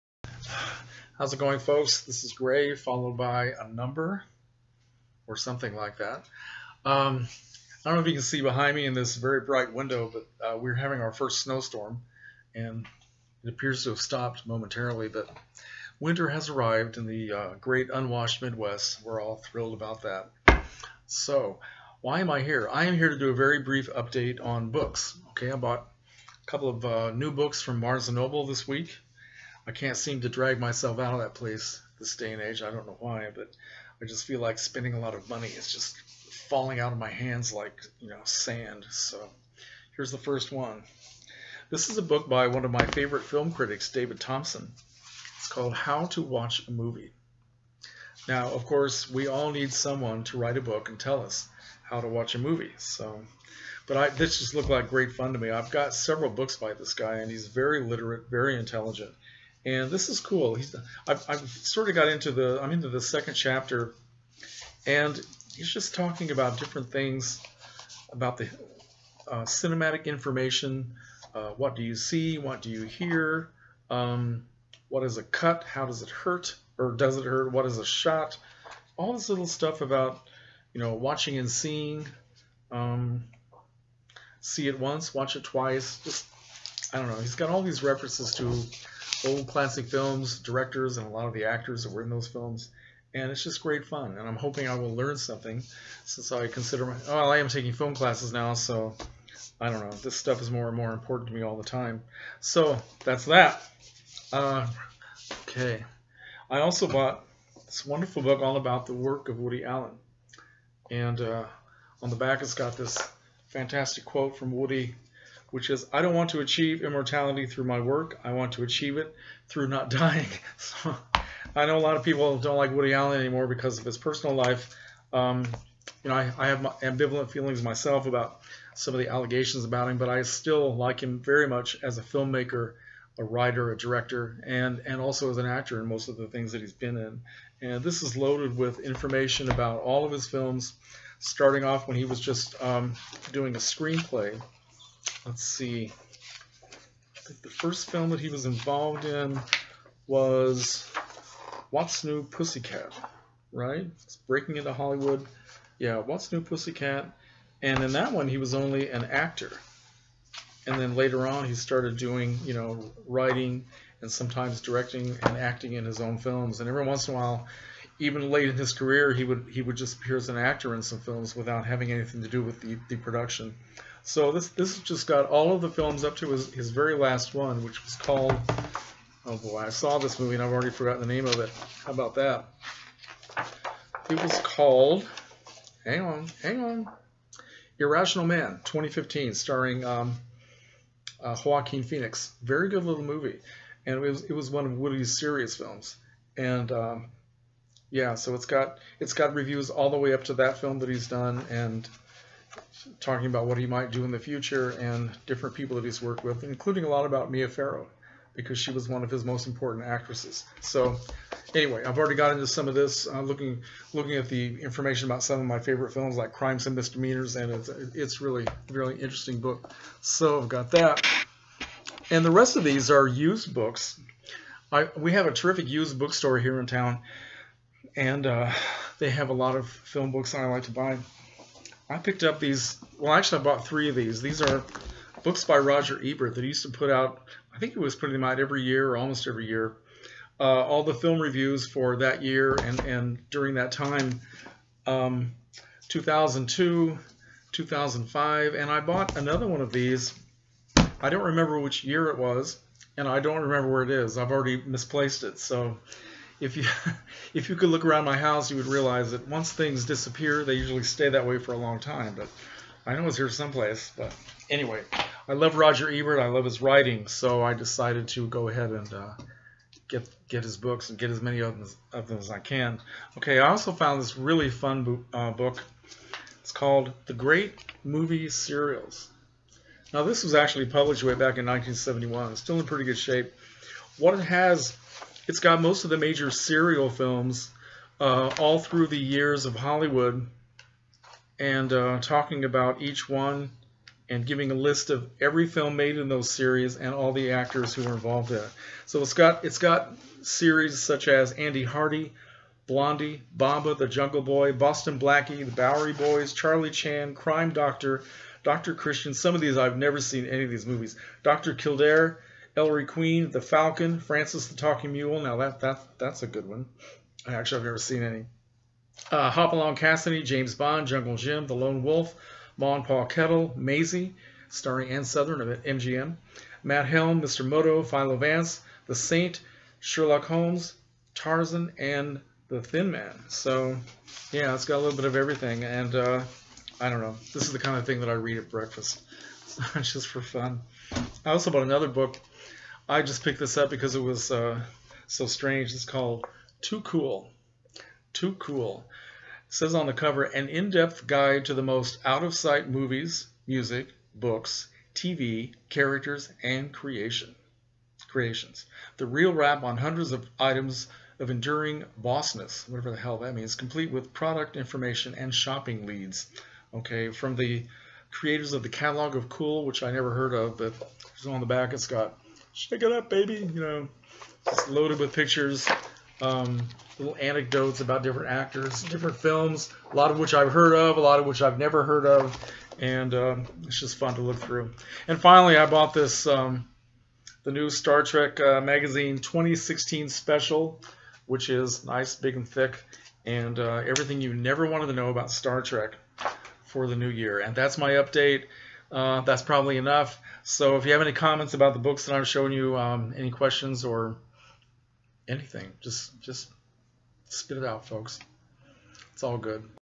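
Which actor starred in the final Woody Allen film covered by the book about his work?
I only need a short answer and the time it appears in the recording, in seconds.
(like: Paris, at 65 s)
Joaquin Phoenix, at 191 s.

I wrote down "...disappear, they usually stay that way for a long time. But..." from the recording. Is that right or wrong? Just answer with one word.
right.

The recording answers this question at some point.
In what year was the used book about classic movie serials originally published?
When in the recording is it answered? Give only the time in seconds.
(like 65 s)
281 s.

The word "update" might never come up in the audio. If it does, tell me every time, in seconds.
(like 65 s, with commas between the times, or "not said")
23 s, 397 s.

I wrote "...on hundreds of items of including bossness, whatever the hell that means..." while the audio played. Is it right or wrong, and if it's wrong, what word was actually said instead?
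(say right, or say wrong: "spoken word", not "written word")
wrong: "enduring", not "including".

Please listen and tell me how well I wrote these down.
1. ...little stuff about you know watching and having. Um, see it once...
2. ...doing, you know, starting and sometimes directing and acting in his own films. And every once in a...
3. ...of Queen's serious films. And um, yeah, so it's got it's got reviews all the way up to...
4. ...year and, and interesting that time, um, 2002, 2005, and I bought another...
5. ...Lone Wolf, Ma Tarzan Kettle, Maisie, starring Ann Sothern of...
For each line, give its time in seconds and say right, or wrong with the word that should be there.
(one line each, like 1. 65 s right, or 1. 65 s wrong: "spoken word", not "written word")
1. 79 s wrong: "seeing", not "having"
2. 161 s wrong: "writing", not "starting"
3. 194 s wrong: "Woody", not "Queen"
4. 242 s wrong: "during", not "interesting"
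5. 321 s wrong: "Paul", not "Tarzan".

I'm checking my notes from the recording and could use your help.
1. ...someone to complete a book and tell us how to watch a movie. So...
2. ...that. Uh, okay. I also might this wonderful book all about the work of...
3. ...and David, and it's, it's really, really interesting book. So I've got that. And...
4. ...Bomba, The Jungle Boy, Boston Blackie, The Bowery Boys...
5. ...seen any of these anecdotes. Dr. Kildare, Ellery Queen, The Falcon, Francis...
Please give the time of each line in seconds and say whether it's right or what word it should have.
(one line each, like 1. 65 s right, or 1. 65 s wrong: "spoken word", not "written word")
1. 49 s wrong: "write", not "complete"
2. 103 s wrong: "bought", not "might"
3. 216 s wrong: "Misdemeanors", not "David"
4. 303 s right
5. 310 s wrong: "movies", not "anecdotes".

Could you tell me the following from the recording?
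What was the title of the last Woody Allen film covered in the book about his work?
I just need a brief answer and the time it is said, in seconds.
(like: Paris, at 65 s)
Irrational Man, at 187 s.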